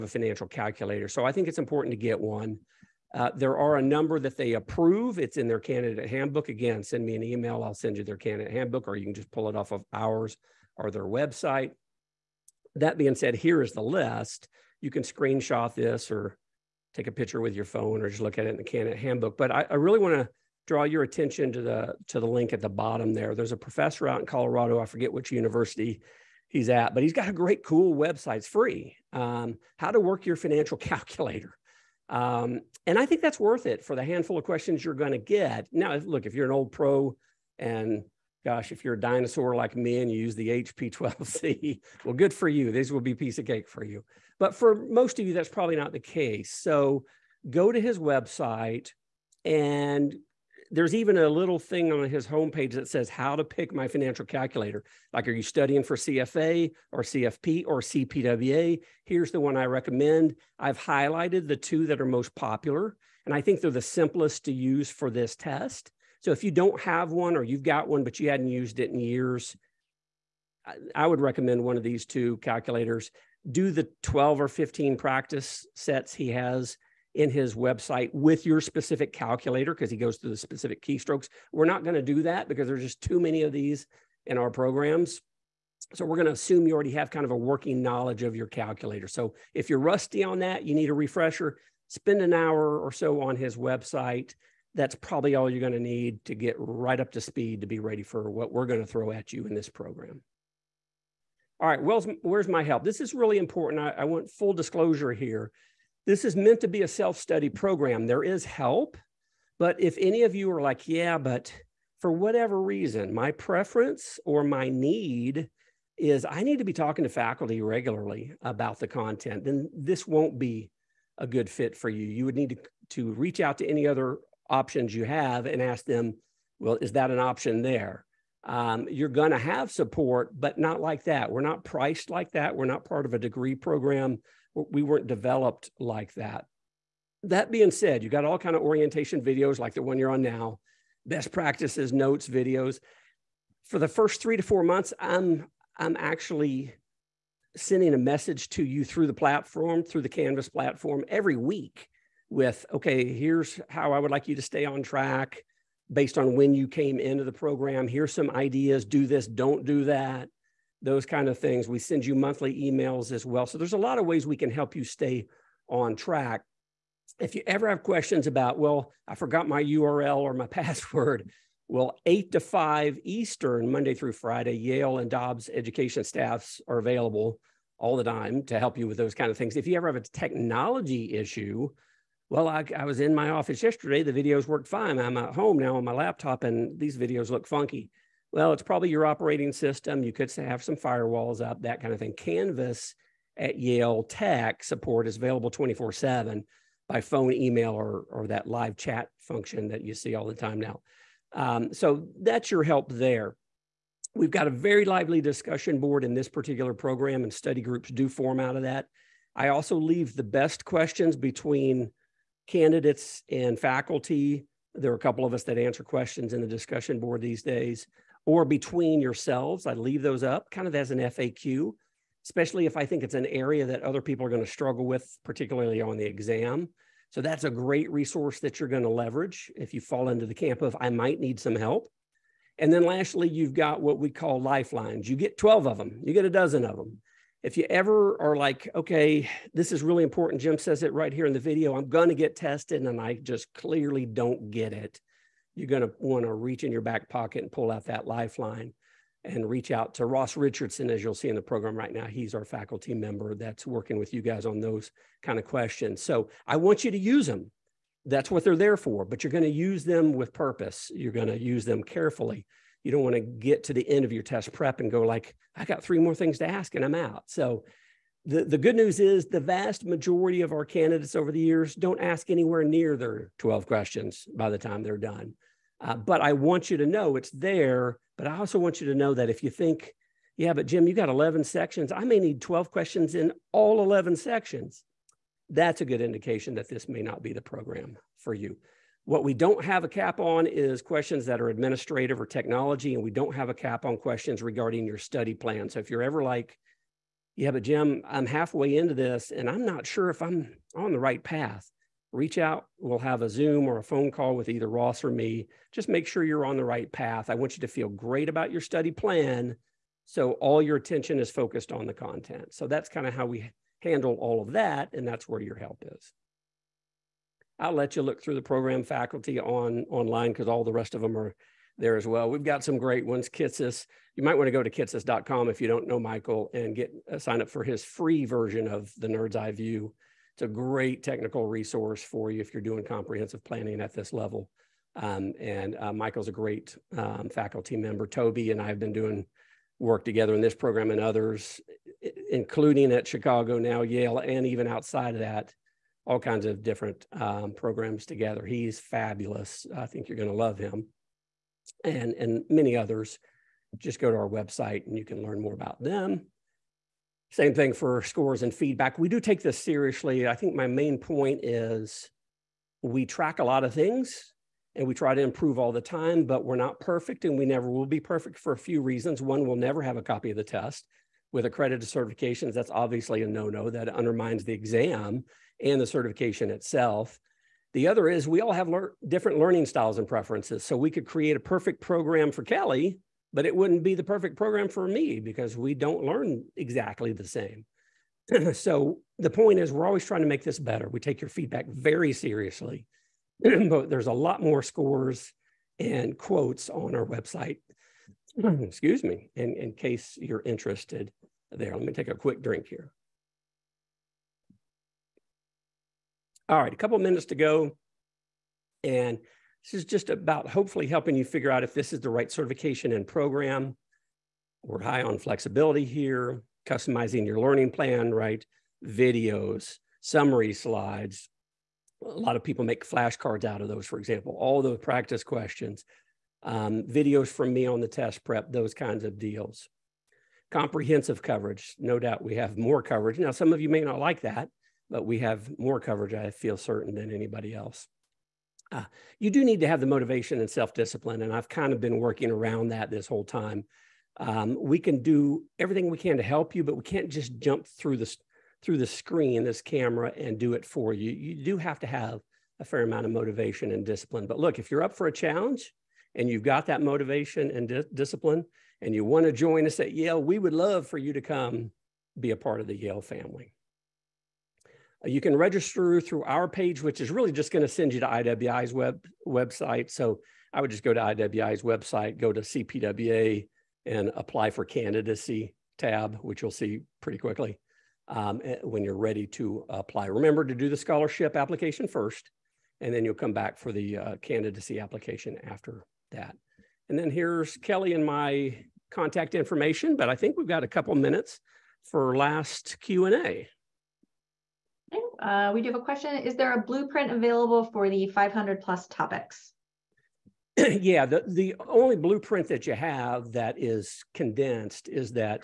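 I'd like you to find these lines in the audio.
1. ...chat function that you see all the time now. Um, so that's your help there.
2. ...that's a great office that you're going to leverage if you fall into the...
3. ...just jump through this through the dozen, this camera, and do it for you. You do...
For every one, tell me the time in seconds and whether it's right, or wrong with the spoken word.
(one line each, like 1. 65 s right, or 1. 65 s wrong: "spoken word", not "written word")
1. 198 s right
2. 227 s wrong: "resource", not "office"
3. 447 s wrong: "screen", not "dozen".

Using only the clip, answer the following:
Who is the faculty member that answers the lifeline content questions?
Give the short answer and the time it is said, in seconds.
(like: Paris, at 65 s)
Ross Richardson, at 250 s.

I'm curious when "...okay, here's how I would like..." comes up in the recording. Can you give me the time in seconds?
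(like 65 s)
152 s.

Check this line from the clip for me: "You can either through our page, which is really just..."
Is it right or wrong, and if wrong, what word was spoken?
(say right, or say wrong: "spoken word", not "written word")
wrong: "register", not "either".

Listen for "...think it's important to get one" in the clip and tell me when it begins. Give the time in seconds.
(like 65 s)
1 s.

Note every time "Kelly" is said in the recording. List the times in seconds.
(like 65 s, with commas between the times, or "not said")
382 s, 487 s.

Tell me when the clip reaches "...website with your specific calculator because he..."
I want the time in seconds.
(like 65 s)
77 s.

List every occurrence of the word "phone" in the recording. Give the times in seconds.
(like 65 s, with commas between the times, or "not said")
17 s, 197 s, 303 s.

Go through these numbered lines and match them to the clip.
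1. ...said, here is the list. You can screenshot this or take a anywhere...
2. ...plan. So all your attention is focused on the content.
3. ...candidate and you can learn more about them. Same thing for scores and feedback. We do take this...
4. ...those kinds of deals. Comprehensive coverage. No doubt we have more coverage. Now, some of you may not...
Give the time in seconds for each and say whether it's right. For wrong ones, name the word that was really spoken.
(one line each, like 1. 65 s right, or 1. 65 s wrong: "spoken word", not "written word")
1. 13 s wrong: "picture", not "anywhere"
2. 308 s right
3. 354 s wrong: "website", not "candidate"
4. 428 s right.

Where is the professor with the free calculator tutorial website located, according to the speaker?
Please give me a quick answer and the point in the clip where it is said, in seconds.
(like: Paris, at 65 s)
Colorado, at 24 s.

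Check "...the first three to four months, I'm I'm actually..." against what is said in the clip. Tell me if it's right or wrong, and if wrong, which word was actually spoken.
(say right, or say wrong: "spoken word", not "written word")
right.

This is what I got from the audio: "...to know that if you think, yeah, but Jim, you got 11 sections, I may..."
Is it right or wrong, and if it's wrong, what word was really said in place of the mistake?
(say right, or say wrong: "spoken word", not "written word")
right.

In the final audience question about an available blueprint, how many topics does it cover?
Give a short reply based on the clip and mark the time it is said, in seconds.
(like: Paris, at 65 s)
500 plus, at 498 s.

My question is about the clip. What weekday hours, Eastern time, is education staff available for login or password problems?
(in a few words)
8 to 5.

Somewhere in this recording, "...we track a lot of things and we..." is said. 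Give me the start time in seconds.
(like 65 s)
362 s.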